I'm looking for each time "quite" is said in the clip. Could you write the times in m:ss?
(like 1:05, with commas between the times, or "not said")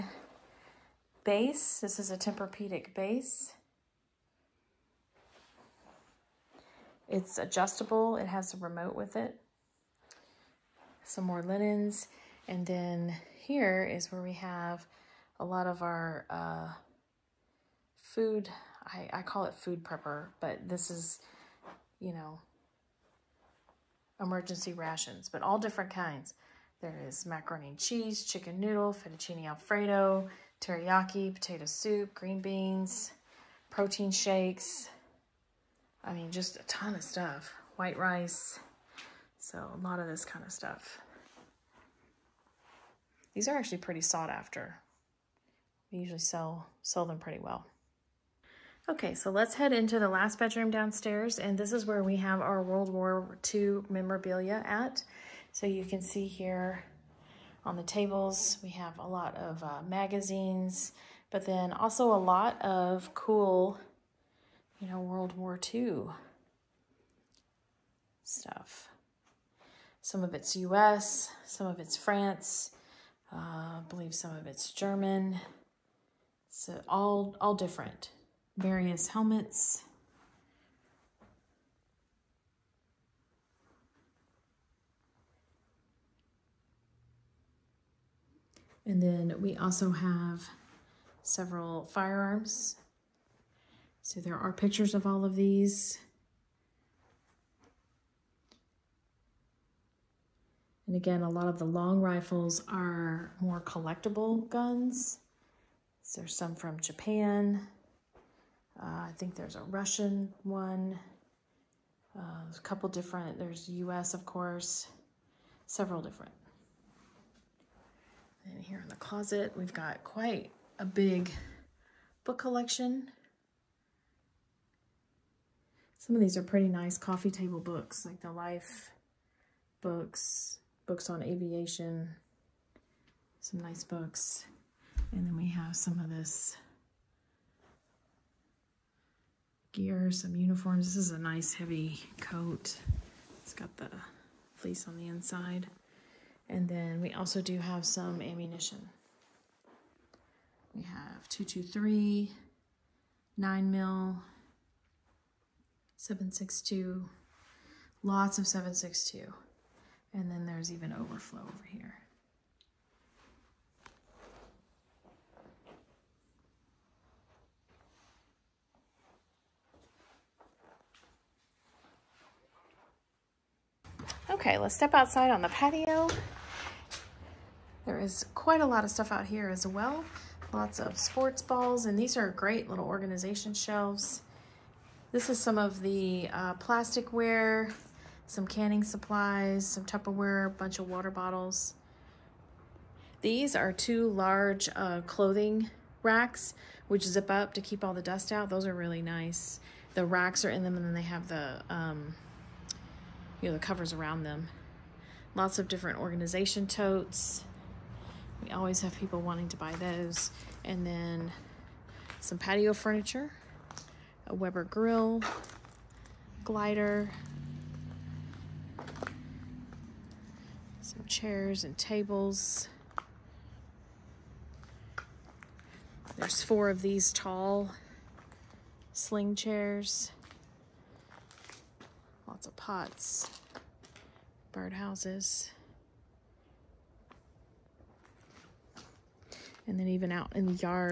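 2:00, 2:58.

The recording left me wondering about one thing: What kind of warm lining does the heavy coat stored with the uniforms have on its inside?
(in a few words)
Fleece.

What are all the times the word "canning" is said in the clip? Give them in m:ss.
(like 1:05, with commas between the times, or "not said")
3:08.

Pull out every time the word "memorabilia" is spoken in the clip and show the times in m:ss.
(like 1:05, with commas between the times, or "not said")
0:53.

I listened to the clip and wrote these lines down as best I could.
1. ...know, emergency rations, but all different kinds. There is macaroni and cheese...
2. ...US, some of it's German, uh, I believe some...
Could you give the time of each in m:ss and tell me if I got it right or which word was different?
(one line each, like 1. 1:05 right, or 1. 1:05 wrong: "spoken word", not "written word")
1. 0:22 right
2. 1:10 wrong: "France", not "German".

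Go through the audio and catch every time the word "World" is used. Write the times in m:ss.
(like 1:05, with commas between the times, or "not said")
0:52, 1:05.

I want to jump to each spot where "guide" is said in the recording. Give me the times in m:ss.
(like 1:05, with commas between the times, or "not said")
not said.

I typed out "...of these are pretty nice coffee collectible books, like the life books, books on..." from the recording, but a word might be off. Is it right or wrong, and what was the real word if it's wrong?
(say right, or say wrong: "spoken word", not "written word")
wrong: "table", not "collectible".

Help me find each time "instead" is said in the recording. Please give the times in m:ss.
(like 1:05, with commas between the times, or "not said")
not said.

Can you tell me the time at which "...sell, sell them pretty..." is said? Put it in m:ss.
0:46.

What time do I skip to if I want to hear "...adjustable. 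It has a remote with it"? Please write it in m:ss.
0:07.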